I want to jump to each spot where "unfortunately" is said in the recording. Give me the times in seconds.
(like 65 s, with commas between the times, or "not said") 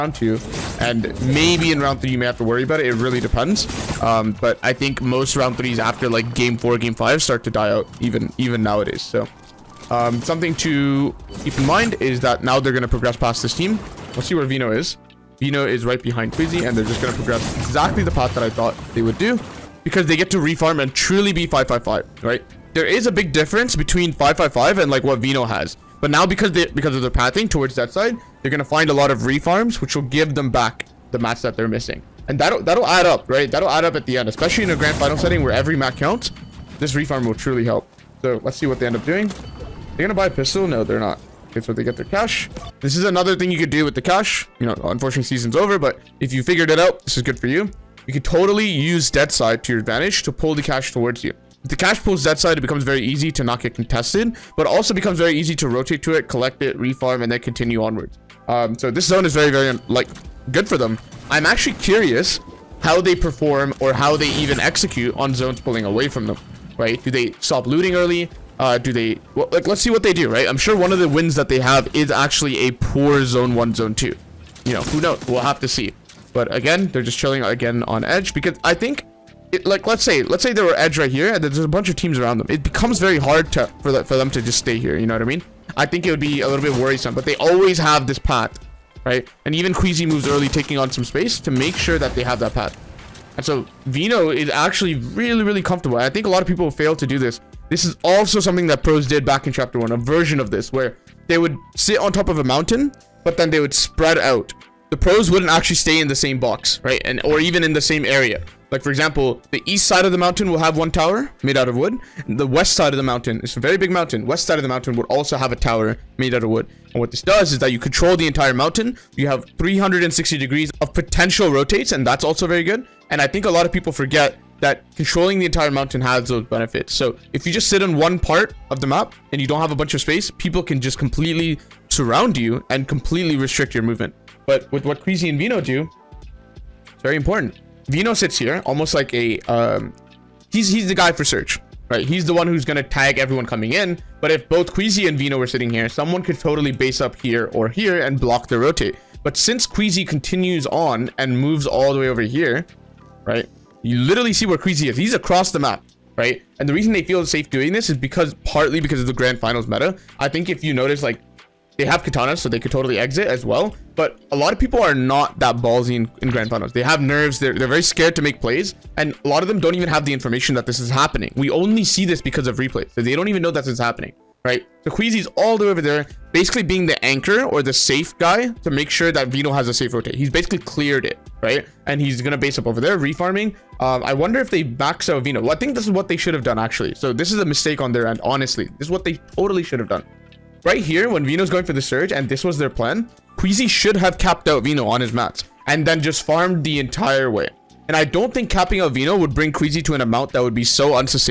44 s.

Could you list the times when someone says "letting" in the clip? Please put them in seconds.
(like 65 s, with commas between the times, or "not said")
not said.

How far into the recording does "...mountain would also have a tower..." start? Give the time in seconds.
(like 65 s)
114 s.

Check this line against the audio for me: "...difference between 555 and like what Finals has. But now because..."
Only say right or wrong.
wrong.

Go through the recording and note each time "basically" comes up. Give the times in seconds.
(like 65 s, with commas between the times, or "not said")
176 s, 180 s.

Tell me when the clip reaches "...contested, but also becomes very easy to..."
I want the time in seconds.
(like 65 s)
53 s.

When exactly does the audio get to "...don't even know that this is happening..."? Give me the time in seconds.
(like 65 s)
173 s.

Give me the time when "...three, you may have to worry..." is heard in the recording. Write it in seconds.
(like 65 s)
1 s.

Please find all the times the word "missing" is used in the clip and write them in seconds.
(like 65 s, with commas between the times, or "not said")
31 s.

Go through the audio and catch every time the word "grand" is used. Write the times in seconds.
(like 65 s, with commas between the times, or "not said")
34 s, 159 s, 166 s.